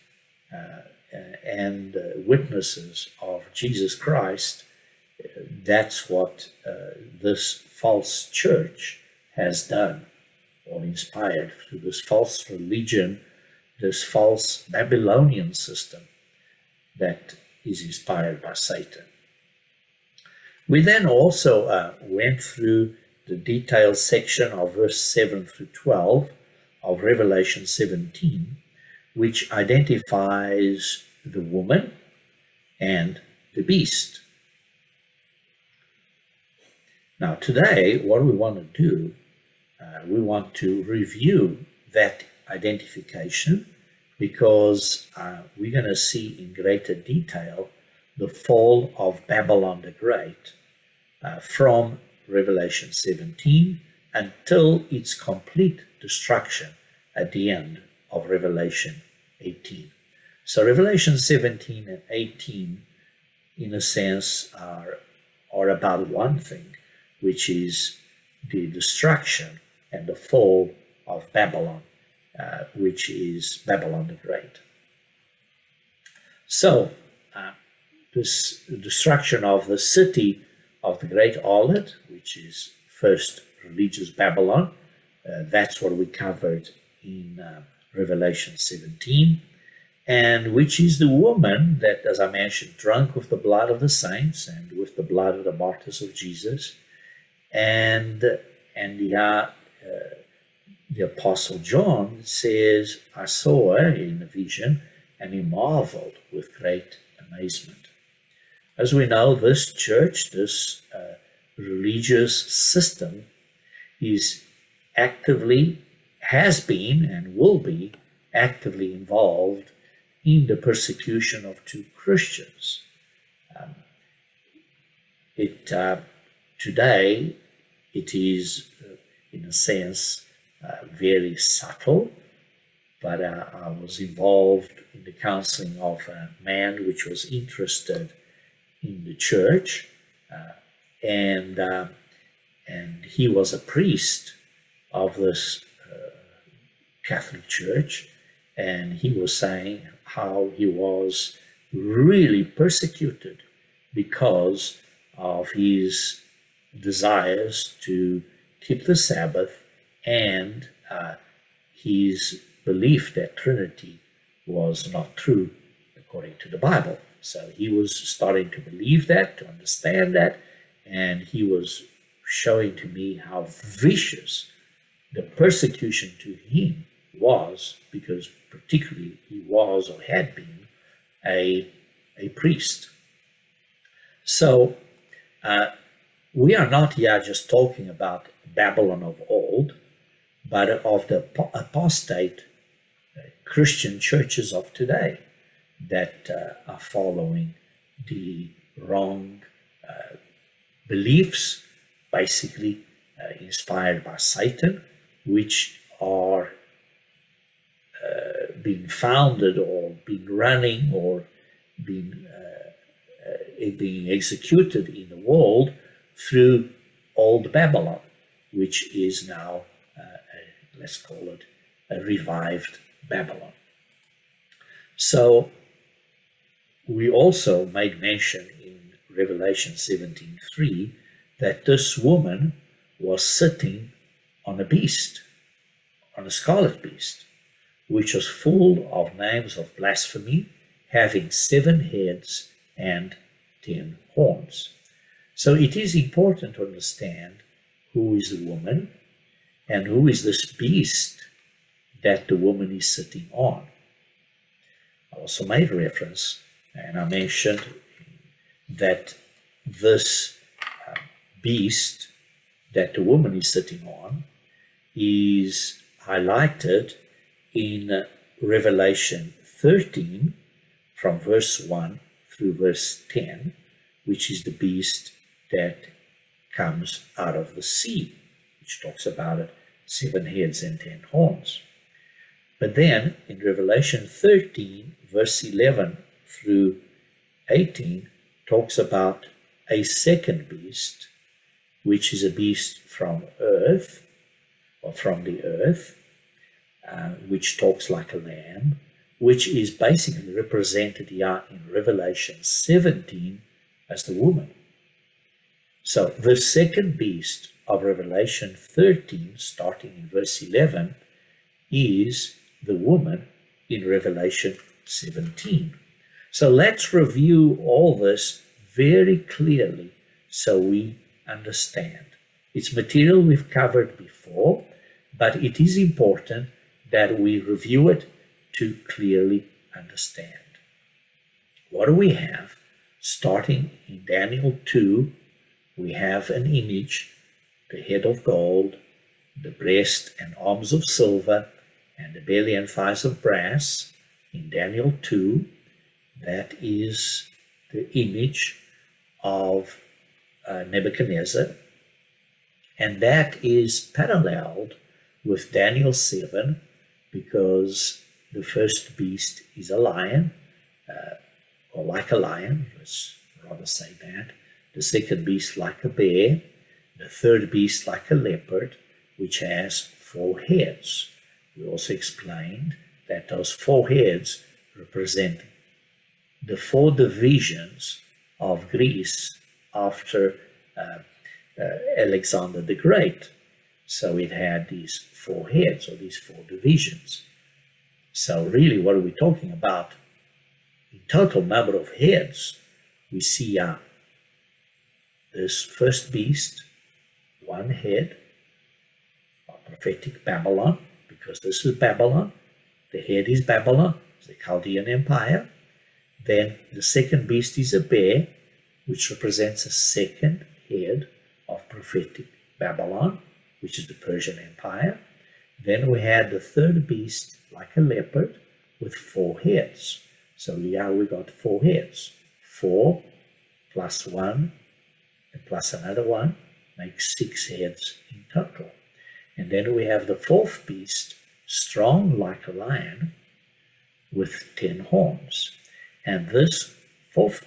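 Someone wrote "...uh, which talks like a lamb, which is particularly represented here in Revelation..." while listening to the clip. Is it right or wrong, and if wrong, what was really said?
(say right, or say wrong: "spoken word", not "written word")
wrong: "basically", not "particularly".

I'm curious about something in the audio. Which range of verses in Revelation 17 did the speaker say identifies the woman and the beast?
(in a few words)
7 through 12.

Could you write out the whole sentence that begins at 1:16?
So, uh, this destruction of the city of the great harlot, which is first religious Babylon.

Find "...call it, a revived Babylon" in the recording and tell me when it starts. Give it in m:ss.
3:40.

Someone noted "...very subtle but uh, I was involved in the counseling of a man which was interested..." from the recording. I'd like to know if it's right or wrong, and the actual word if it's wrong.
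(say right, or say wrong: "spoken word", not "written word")
right.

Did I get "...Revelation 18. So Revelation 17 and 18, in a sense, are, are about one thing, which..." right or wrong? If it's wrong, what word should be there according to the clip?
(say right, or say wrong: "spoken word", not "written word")
right.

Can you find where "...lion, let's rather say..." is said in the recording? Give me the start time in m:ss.
6:02.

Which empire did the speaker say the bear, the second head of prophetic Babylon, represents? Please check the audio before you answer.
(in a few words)
Persian Empire.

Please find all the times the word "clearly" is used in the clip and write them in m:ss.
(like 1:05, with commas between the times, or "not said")
5:19, 5:28.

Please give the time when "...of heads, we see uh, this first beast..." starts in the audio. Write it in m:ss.
6:31.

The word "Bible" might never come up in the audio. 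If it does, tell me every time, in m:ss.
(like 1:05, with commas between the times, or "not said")
2:46.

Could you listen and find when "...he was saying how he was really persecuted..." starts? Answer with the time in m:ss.
2:28.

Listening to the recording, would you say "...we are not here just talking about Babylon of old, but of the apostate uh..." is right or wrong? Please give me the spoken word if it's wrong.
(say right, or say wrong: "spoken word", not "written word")
right.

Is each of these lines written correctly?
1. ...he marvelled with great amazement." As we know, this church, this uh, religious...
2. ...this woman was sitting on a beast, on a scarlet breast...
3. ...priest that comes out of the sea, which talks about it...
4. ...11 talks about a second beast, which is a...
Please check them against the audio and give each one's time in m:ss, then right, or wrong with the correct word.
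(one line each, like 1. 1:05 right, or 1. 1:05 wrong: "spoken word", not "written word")
1. 1:45 right
2. 3:51 wrong: "beast", not "breast"
3. 4:34 wrong: "beast", not "priest"
4. 4:47 wrong: "18", not "11".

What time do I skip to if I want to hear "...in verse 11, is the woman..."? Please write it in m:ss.
5:09.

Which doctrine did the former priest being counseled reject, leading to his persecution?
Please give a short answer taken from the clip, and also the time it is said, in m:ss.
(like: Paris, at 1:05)
Trinity, at 2:43.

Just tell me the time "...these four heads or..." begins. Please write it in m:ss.
6:24.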